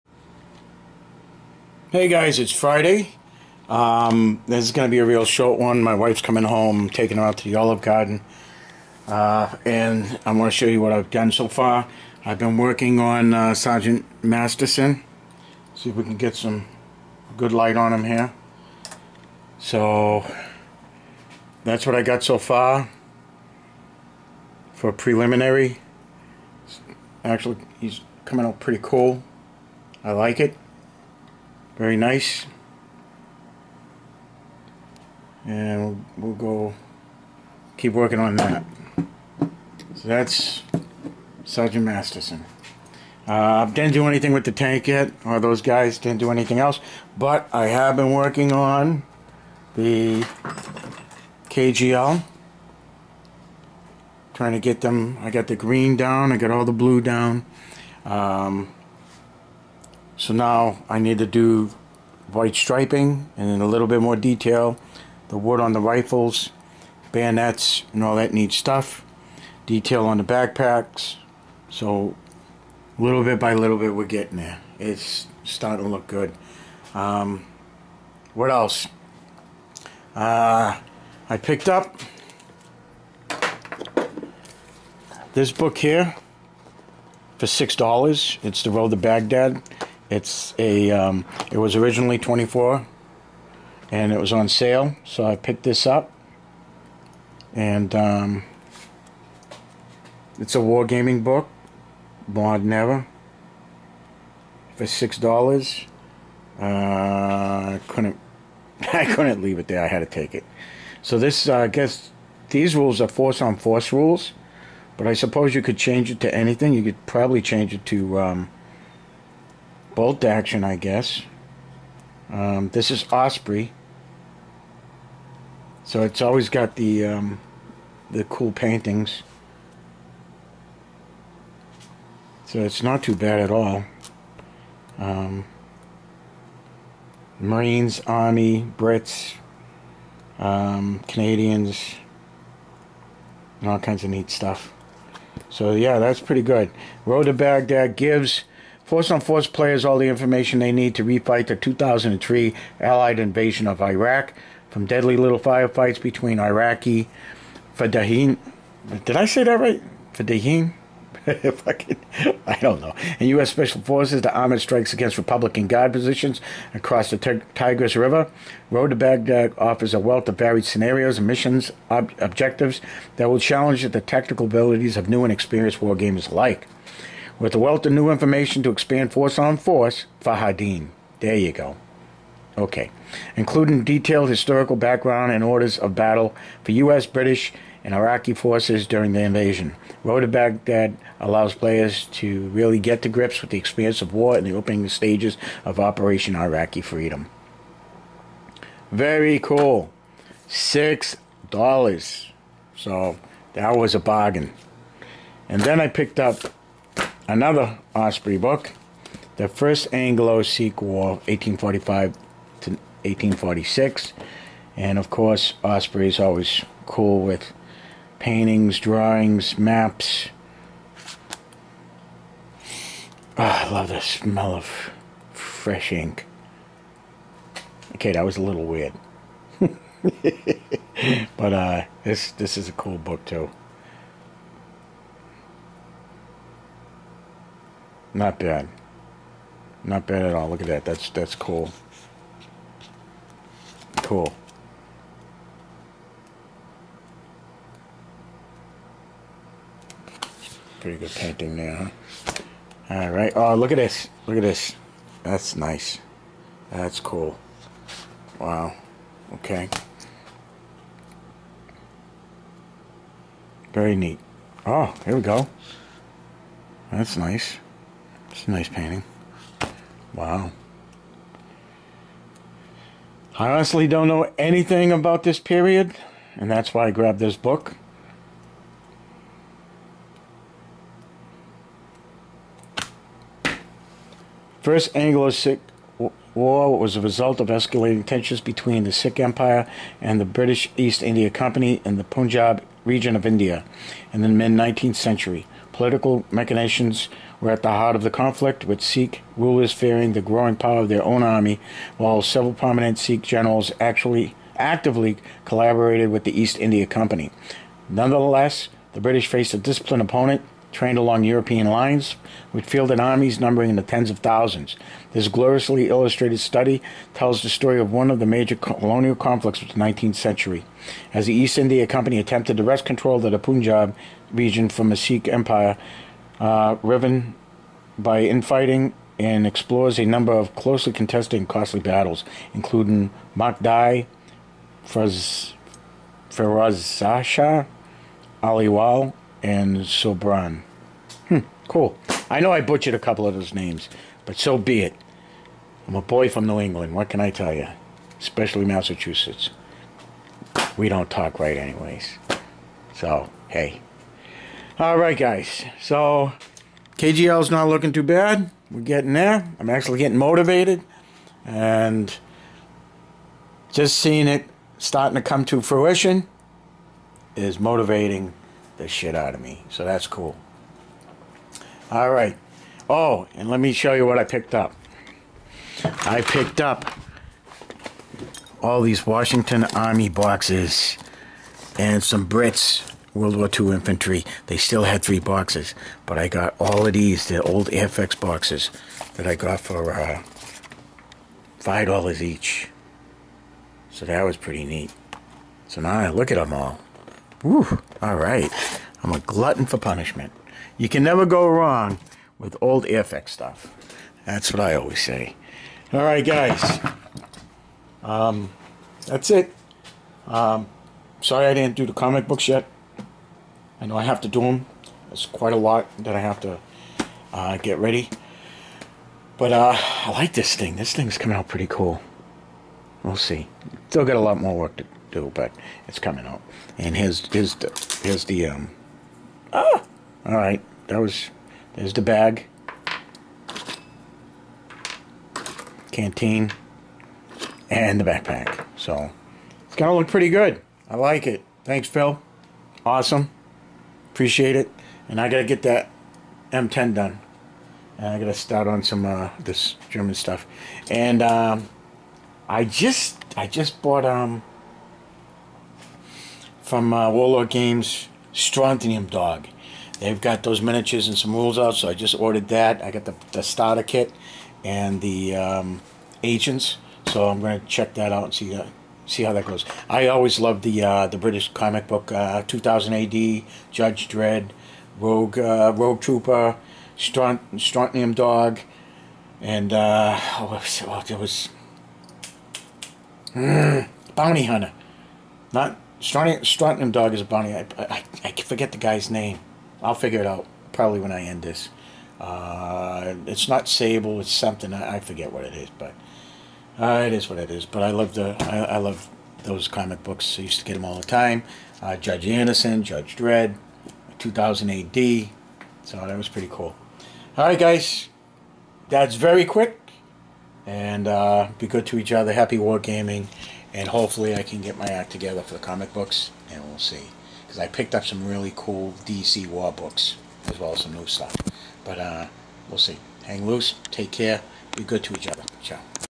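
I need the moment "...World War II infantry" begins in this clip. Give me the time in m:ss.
6:23.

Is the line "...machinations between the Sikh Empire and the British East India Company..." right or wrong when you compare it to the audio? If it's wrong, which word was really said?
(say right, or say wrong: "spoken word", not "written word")
wrong: "tensions", not "machinations".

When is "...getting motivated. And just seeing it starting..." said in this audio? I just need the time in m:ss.
5:59.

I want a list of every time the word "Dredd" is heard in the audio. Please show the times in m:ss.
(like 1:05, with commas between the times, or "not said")
7:54, 8:23.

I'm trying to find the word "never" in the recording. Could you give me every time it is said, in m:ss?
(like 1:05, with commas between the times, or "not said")
1:42, 6:41.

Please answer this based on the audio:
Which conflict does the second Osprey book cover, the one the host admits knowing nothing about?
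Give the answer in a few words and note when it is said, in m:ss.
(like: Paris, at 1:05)
First Anglo-Sikh War, at 3:29.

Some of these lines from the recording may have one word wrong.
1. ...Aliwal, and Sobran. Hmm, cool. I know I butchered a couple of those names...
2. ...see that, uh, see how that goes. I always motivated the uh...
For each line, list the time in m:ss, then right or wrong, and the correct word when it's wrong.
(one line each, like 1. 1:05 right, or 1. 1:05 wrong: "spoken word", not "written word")
1. 5:38 right
2. 7:48 wrong: "loved", not "motivated".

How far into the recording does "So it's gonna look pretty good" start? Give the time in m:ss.
7:18.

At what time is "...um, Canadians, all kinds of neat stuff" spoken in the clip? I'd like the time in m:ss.
2:20.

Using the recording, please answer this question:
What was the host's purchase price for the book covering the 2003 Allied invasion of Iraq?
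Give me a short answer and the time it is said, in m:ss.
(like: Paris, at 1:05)
$6, at 1:44.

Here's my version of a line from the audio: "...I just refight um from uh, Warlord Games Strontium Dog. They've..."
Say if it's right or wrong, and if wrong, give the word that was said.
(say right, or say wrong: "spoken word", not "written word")
wrong: "bought", not "refight".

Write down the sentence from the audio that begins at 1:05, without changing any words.
The wood on the rifles, bayonets, and all that neat stuff.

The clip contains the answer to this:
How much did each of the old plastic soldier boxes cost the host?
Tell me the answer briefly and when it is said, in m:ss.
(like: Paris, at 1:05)
$5, at 6:31.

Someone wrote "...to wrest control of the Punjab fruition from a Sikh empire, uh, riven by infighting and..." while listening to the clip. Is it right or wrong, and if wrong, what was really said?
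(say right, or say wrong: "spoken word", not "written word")
wrong: "region", not "fruition".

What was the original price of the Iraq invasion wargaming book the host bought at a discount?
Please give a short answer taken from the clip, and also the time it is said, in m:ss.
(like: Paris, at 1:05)
24, at 1:32.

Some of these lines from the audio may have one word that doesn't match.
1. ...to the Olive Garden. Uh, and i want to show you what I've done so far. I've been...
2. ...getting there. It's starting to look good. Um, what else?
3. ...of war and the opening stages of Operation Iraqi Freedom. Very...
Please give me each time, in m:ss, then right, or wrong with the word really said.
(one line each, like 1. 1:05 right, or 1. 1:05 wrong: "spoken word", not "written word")
1. 0:07 right
2. 1:14 right
3. 3:14 right.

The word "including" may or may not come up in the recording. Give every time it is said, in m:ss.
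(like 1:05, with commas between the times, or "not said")
3:03, 5:32.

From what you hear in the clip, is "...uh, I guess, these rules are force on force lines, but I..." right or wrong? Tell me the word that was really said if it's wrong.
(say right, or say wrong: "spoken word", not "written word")
wrong: "rules", not "lines".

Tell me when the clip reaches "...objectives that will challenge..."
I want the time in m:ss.
2:52.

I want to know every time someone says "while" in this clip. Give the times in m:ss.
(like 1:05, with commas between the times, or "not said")
5:01.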